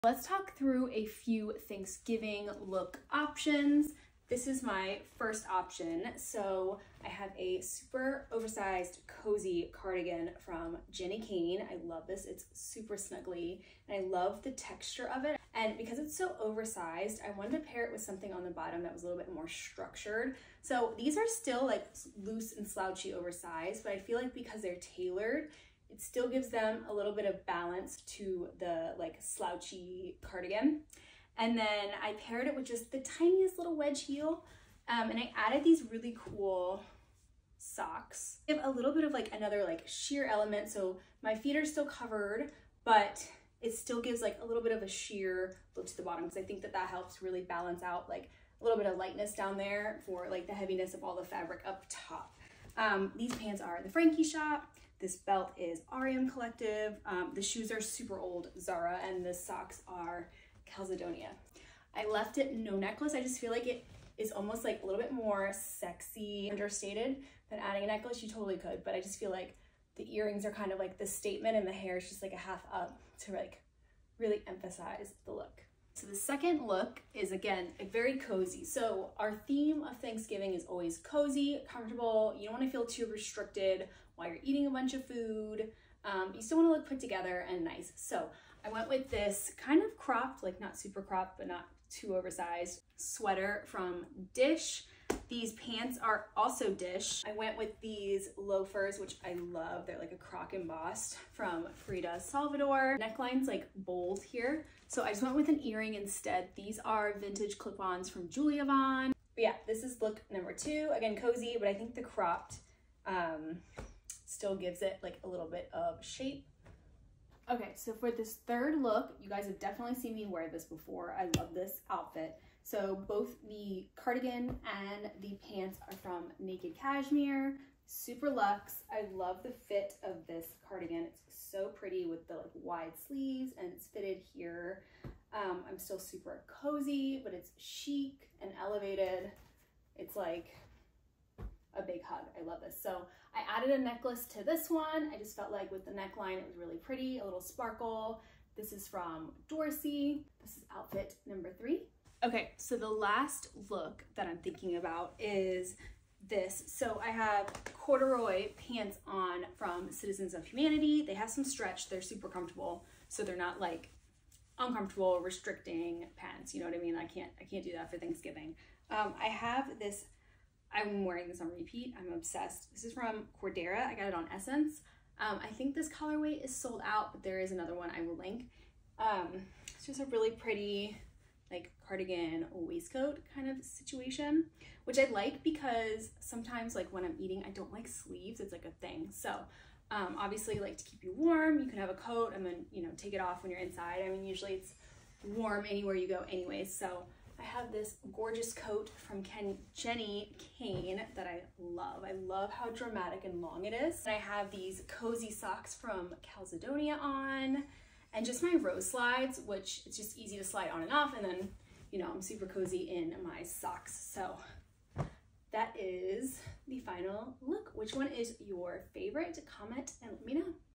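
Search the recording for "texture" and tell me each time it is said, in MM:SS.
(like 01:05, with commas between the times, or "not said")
00:14.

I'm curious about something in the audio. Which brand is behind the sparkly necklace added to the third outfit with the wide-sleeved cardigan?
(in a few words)
Dorsey.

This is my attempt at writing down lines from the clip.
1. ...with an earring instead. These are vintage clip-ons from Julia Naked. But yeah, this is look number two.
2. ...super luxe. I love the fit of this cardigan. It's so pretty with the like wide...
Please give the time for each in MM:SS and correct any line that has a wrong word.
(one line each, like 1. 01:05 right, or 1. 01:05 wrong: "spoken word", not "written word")
1. 01:45 wrong: "Vaughn", not "Naked"
2. 02:07 right.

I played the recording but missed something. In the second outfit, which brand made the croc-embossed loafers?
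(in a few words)
Frida Salvador.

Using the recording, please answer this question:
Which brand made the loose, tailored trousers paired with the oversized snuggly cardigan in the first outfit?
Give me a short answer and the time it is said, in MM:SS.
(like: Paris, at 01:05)
The Frankie Shop, at 00:53.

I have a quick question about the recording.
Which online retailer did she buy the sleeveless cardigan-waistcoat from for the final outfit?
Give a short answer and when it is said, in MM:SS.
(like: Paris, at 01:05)
SSENSE, at 02:54.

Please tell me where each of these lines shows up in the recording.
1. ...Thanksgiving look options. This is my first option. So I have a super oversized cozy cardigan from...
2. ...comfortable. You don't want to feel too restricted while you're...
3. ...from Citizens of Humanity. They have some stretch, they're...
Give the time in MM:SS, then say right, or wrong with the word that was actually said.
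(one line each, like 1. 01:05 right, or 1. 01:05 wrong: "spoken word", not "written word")
1. 00:01 right
2. 01:21 right
3. 02:39 right.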